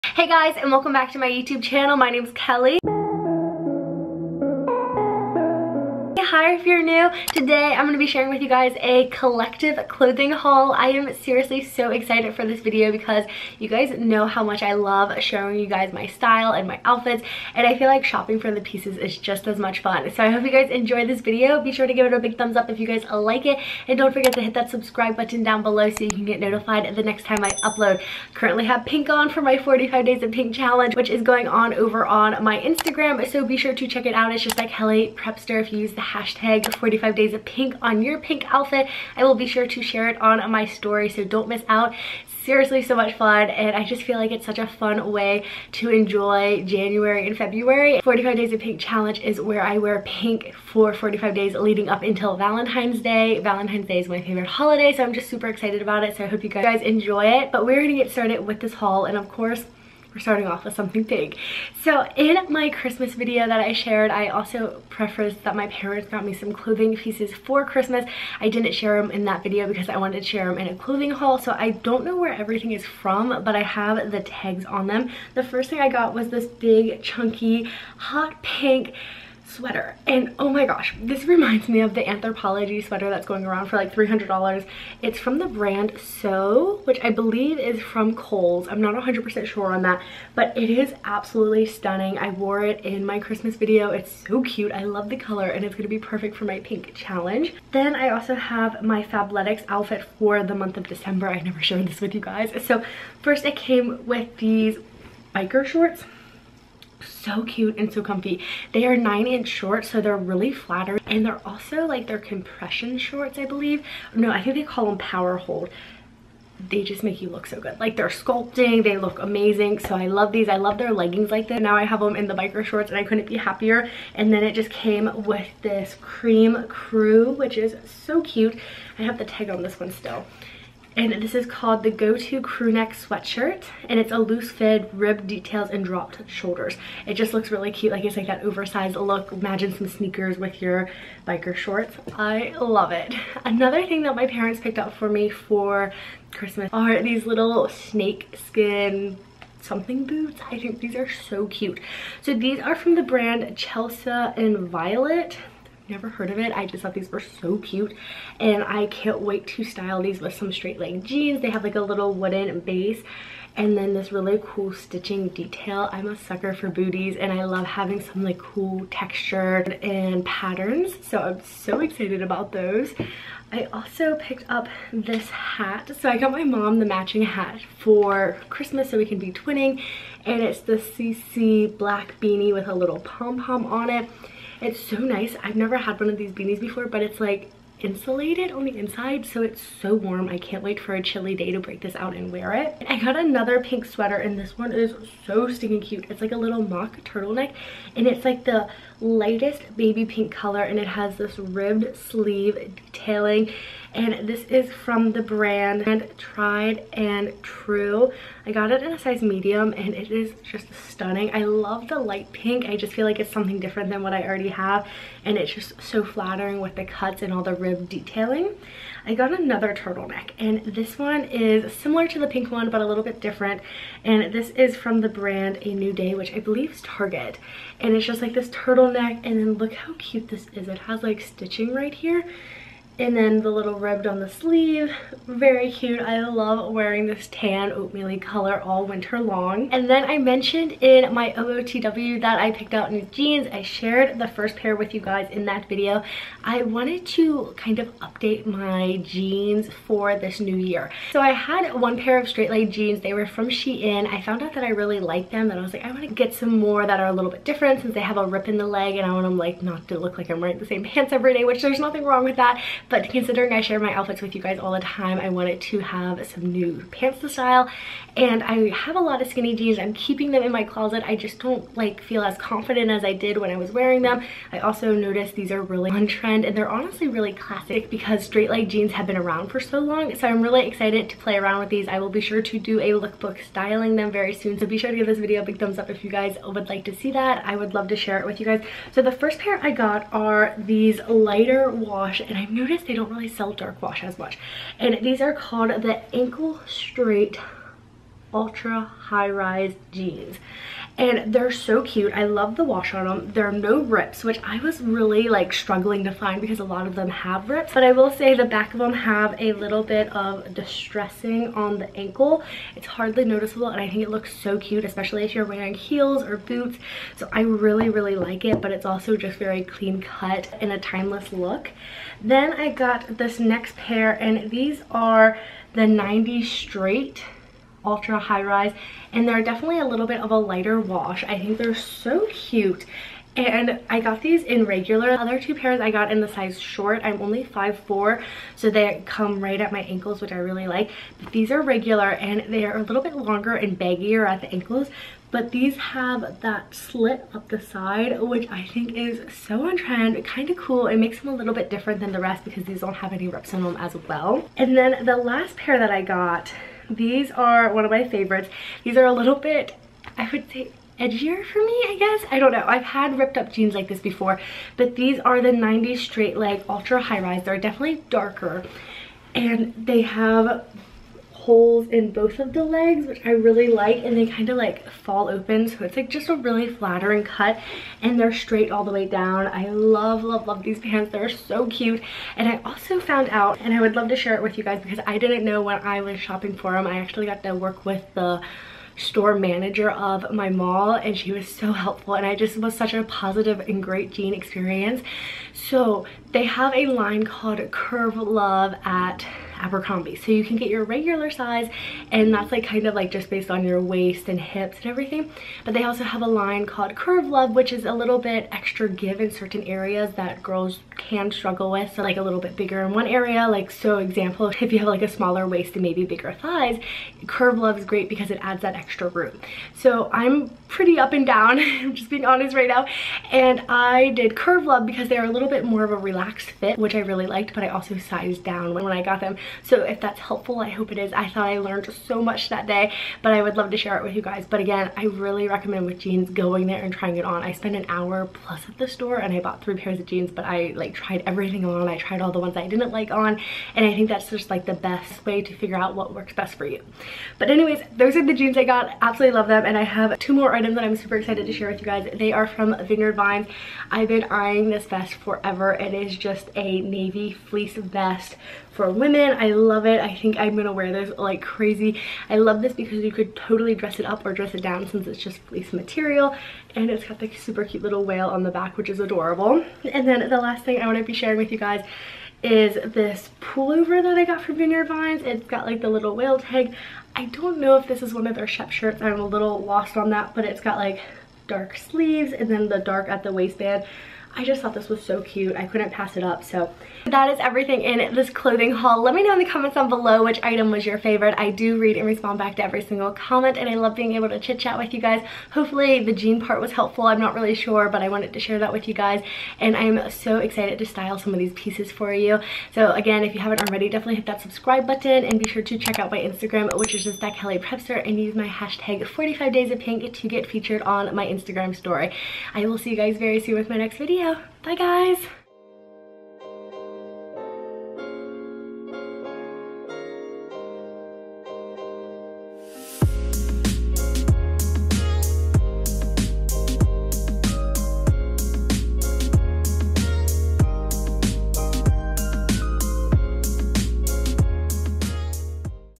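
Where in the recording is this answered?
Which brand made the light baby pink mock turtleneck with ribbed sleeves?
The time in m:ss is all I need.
3:26.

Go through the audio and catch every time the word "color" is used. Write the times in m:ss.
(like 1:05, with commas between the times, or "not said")
1:35, 3:20, 3:58.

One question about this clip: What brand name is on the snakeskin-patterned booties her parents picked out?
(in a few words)
Chelsea and Violet.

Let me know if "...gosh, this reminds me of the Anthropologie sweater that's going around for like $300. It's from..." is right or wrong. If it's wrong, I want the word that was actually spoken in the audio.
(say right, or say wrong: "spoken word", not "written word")
right.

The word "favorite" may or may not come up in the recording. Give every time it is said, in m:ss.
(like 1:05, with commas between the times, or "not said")
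0:54, 5:58, 8:10.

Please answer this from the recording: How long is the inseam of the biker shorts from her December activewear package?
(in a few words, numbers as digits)
9 inches.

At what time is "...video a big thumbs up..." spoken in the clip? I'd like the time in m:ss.
4:45.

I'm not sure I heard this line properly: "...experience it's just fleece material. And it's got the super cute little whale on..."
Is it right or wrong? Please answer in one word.
wrong.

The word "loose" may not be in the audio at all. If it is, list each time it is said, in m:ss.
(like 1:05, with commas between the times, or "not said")
2:14.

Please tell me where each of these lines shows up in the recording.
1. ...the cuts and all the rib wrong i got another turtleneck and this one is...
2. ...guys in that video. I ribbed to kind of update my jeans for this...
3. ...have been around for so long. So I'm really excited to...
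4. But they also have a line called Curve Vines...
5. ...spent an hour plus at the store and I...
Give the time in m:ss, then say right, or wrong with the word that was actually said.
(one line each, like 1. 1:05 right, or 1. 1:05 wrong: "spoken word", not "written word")
1. 3:36 wrong: "detailing", not "wrong"
2. 4:05 wrong: "wanted", not "ribbed"
3. 4:38 right
4. 6:45 wrong: "Love", not "Vines"
5. 7:17 right.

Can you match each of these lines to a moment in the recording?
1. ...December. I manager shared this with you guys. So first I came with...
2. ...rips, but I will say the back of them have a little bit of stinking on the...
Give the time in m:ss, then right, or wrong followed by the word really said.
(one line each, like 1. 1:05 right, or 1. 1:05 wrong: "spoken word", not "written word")
1. 1:40 wrong: "never", not "manager"
2. 5:07 wrong: "distressing", not "stinking".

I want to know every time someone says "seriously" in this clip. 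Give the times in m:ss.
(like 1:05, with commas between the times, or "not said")
0:11, 0:42.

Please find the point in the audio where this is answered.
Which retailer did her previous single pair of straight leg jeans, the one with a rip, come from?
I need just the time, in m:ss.
4:13.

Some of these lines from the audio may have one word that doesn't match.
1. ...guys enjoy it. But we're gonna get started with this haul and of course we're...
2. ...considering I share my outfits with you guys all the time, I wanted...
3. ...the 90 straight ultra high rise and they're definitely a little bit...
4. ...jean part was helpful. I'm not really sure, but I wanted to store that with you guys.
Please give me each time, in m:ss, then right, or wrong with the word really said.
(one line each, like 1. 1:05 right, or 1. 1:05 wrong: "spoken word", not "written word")
1. 0:56 right
2. 4:23 right
3. 5:25 right
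4. 8:16 wrong: "share", not "store".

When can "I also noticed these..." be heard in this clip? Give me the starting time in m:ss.
4:34.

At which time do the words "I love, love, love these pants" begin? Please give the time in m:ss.
6:19.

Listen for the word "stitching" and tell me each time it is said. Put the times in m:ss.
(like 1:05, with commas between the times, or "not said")
2:44, 3:51.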